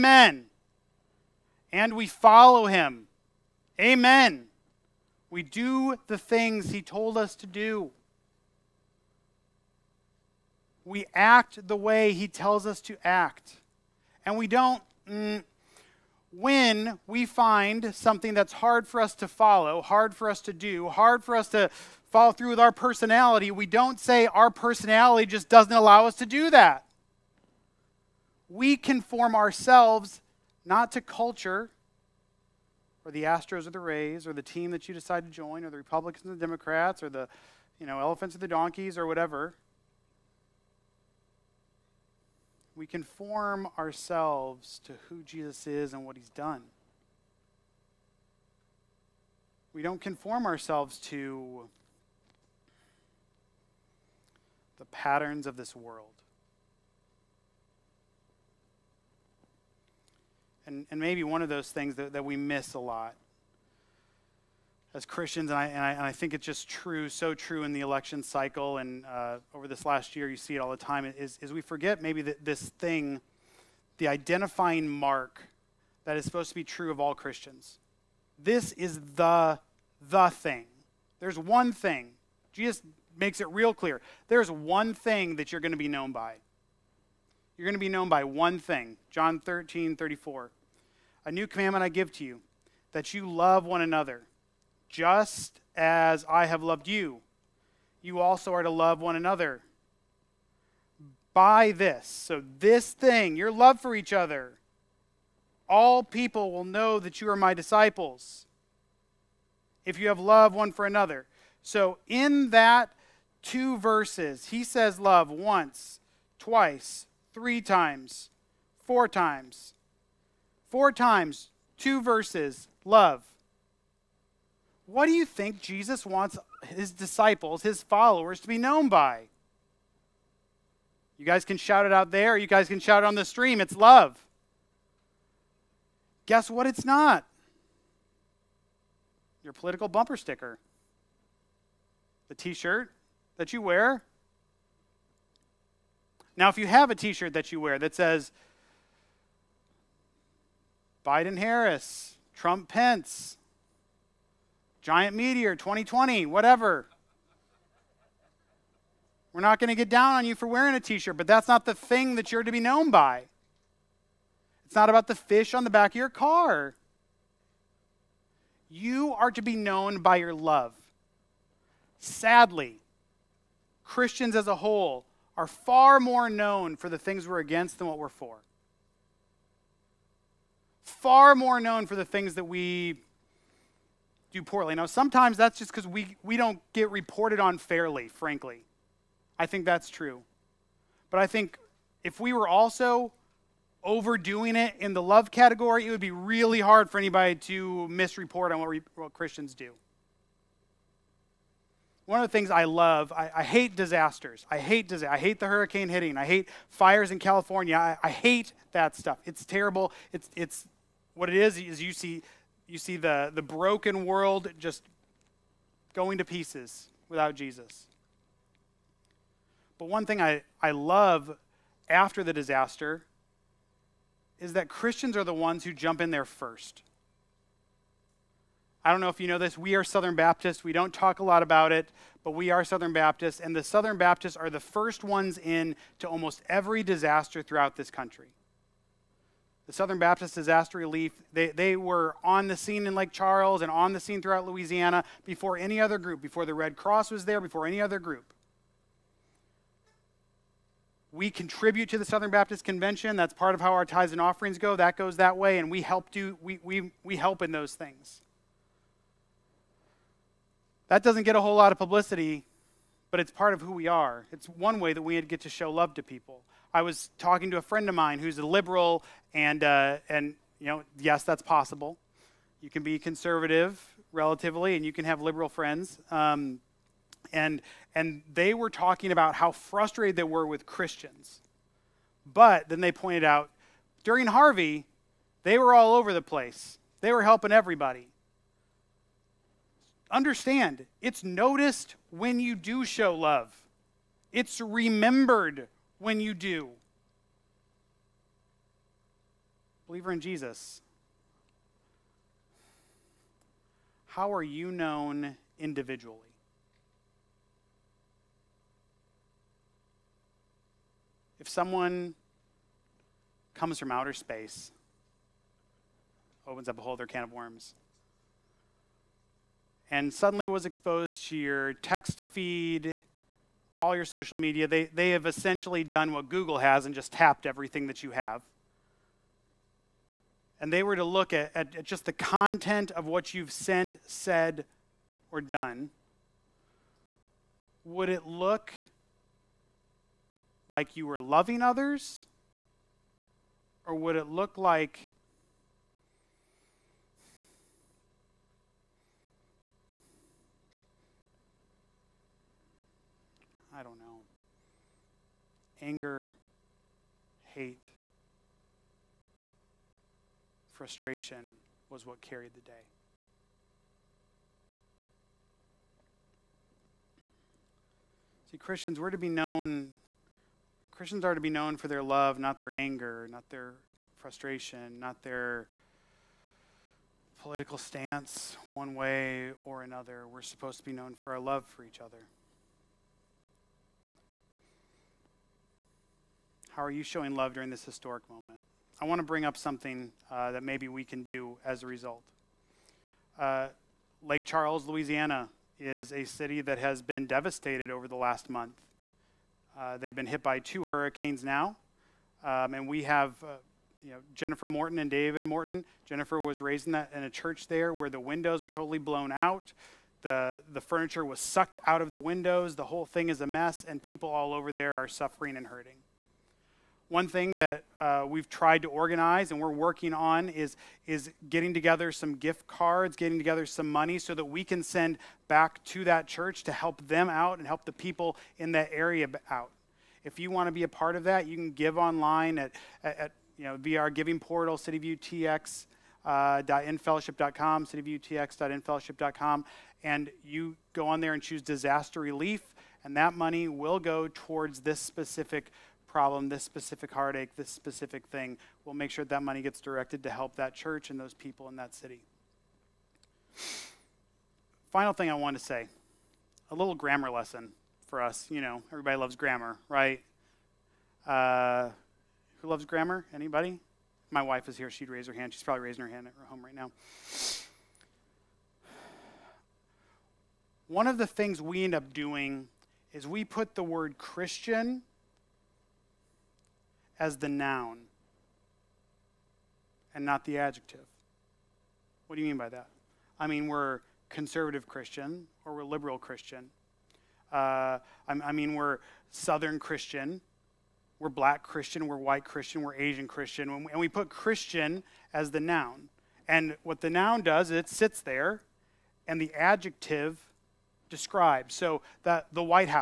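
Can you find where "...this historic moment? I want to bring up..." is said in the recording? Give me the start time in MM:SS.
06:27.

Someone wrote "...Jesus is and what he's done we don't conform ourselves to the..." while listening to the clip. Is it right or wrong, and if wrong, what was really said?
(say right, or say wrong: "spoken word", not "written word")
right.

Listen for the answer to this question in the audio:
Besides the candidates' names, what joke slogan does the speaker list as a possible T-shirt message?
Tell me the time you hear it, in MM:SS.
02:34.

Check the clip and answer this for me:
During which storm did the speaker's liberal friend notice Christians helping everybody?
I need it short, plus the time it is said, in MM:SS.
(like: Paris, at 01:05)
Harvey, at 04:44.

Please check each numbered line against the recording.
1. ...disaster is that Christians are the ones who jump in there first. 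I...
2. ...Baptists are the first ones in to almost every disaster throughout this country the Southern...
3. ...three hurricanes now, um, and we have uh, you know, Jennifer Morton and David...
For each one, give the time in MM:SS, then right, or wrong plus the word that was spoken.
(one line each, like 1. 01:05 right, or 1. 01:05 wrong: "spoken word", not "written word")
1. 03:42 right
2. 03:53 right
3. 06:40 wrong: "two", not "three".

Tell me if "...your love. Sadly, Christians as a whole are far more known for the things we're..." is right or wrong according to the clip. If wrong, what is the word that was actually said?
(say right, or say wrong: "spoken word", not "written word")
right.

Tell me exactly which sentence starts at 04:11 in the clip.
We contribute to the Southern Baptist Convention.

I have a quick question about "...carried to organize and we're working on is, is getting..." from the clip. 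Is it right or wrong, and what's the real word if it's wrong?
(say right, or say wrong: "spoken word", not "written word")
wrong: "tried", not "carried".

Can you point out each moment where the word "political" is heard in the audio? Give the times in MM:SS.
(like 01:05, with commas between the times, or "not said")
02:19, 06:17.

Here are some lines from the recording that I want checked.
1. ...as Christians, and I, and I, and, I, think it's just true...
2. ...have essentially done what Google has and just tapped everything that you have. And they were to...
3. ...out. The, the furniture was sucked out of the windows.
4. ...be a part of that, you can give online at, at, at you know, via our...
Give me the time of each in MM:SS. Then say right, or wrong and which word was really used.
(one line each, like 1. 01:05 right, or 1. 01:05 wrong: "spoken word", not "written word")
1. 01:04 right
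2. 05:25 right
3. 06:49 right
4. 07:10 right.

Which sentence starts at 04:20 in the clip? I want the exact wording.
That doesn't get a whole lot of publicity, but it's part of who we are.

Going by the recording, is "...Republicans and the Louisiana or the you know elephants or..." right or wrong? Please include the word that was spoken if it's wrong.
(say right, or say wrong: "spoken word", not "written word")
wrong: "Democrats", not "Louisiana".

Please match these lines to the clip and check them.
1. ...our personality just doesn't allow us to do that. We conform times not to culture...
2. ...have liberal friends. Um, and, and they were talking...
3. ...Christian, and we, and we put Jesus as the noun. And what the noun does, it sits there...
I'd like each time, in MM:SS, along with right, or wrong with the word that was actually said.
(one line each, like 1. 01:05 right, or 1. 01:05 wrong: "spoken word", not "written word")
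1. 00:24 wrong: "ourselves", not "times"
2. 04:35 right
3. 08:13 wrong: "Christian", not "Jesus".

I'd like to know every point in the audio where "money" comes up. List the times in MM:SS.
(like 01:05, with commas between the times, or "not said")
07:03, 07:23, 07:29.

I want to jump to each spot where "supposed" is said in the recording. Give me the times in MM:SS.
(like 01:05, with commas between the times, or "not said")
01:16, 06:20.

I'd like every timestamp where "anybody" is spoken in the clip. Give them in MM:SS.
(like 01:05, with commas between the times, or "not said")
03:16, 07:43.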